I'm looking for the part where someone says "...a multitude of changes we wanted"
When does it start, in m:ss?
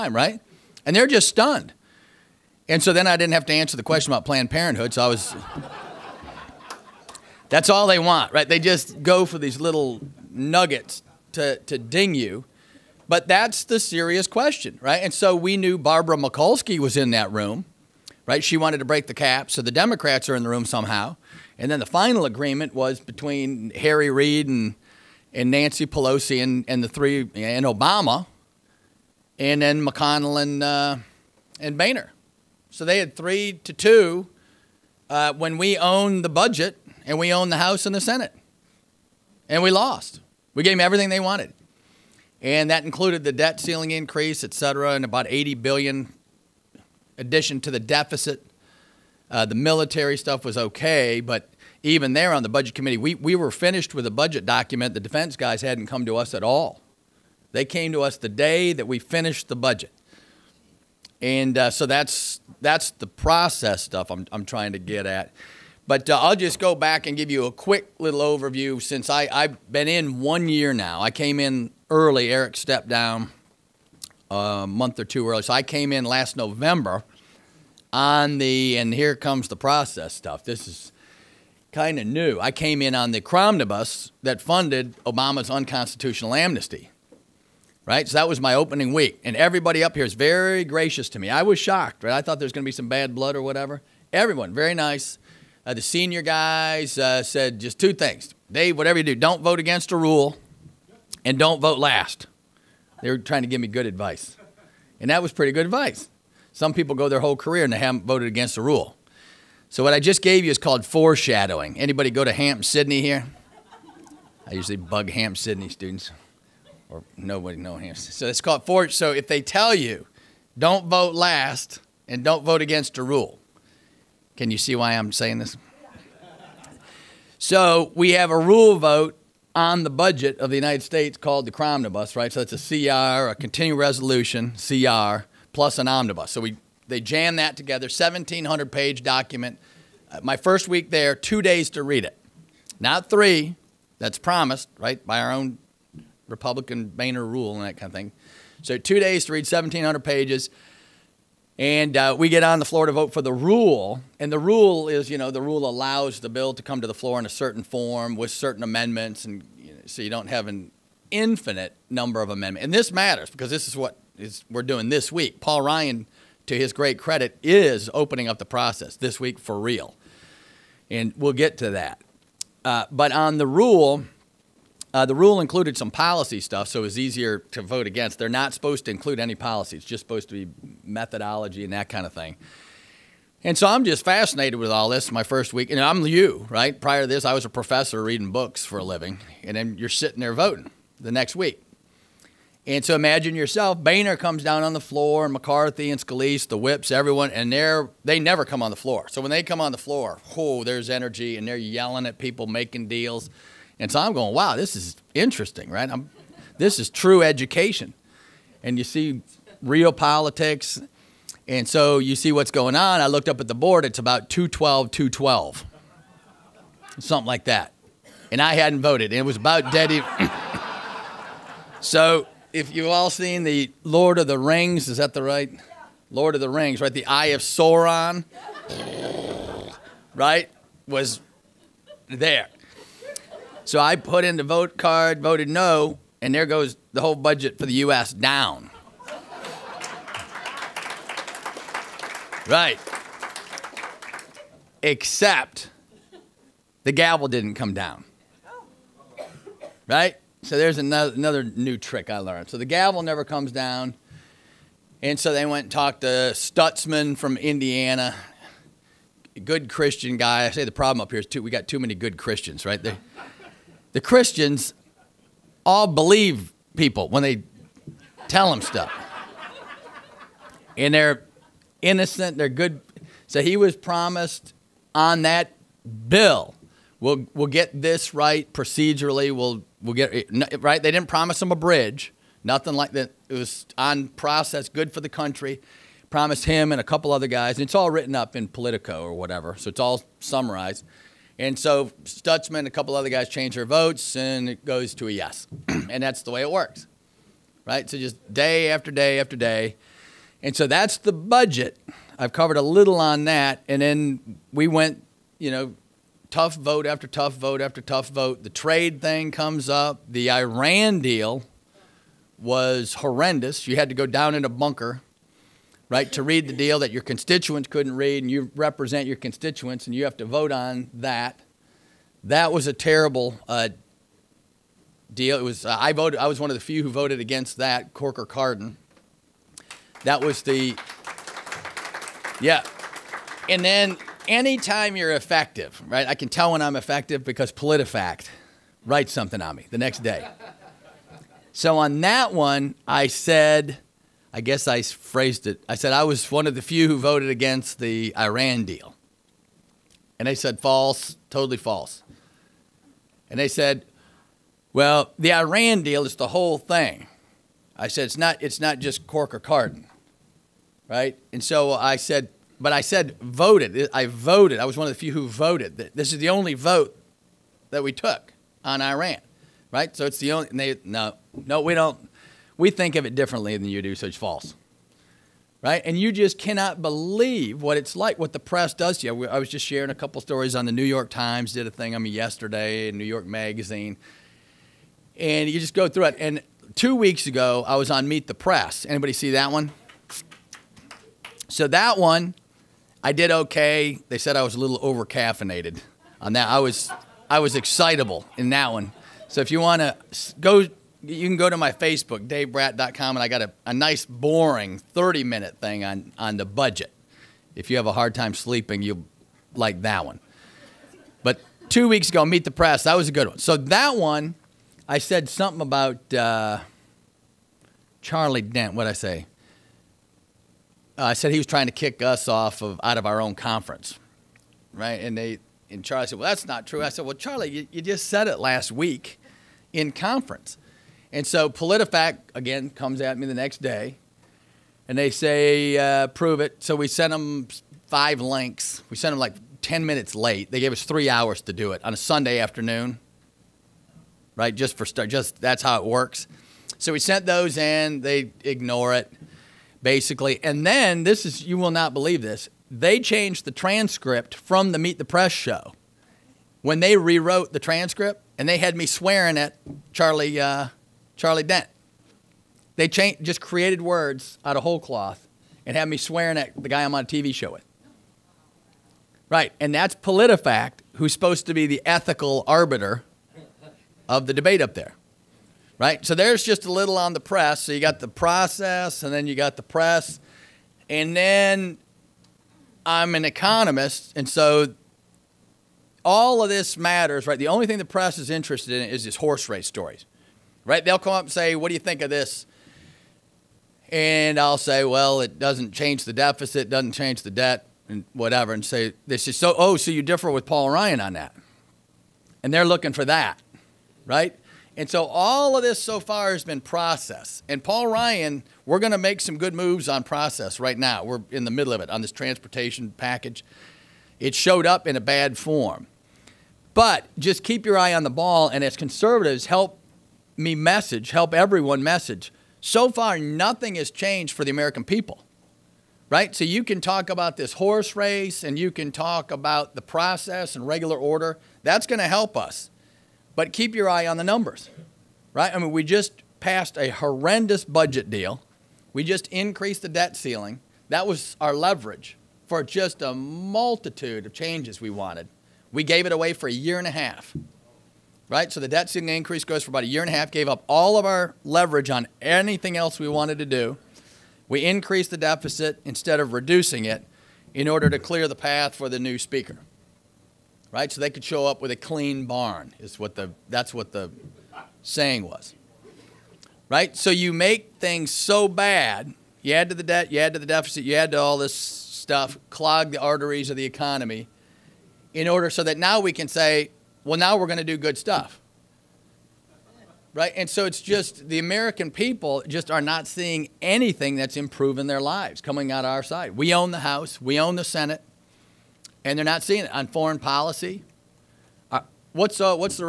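9:03.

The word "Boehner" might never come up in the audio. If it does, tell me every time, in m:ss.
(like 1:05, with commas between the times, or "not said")
0:31, 2:26, 3:13.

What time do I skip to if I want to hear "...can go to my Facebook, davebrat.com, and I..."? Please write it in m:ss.
6:41.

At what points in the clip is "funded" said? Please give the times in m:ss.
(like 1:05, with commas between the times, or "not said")
1:24.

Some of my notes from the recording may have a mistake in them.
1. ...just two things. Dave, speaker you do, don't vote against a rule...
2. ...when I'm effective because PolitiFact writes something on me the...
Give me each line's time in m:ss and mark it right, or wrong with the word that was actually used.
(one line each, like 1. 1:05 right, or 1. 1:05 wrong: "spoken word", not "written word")
1. 1:37 wrong: "whatever", not "speaker"
2. 5:36 right.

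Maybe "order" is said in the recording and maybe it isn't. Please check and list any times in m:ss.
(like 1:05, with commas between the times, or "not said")
8:50, 9:17, 9:35.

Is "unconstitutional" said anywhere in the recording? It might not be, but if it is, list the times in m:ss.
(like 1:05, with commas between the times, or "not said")
1:25.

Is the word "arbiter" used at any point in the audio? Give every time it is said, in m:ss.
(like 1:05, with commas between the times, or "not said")
7:52.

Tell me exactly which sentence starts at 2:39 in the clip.
And you know, so you don't have an infinite number of amendments.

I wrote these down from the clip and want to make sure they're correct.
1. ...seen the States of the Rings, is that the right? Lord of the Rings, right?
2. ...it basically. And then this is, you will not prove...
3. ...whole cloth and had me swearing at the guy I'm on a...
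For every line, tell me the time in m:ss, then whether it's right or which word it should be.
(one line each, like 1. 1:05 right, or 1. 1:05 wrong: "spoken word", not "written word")
1. 3:43 wrong: "Lord", not "States"
2. 7:28 wrong: "believe", not "prove"
3. 7:44 right.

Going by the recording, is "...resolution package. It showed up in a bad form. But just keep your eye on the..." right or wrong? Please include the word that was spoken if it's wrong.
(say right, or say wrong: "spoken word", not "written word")
wrong: "transportation", not "resolution".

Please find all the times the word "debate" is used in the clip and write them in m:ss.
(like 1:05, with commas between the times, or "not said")
7:54.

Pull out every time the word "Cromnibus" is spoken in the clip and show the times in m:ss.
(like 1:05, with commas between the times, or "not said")
1:23, 2:11.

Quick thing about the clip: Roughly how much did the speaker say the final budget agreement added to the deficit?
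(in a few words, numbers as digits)
80 billion.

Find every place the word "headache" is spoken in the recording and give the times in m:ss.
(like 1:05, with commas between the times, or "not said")
not said.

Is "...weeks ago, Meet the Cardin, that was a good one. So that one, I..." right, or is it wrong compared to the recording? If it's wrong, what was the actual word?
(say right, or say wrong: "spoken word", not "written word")
wrong: "Press", not "Cardin".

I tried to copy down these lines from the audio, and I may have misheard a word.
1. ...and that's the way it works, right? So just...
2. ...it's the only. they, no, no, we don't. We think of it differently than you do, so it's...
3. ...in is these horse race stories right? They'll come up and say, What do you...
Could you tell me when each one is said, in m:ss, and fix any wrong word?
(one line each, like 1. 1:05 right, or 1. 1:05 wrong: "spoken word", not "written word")
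1. 4:55 right
2. 6:10 right
3. 8:08 right.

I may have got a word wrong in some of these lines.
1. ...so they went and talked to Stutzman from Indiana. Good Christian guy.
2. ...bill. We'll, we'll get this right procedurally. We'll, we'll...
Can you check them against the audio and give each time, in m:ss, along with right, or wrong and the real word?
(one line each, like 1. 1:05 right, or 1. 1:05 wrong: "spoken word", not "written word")
1. 4:15 right
2. 4:36 right.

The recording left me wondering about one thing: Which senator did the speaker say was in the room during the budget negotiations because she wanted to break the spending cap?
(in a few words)
Barbara Mikulski.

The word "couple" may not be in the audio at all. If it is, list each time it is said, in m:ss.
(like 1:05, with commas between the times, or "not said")
4:46, 4:52, 6:19.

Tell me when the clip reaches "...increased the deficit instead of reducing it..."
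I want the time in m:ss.
9:14.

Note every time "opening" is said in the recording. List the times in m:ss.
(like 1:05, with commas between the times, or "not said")
1:28, 2:47.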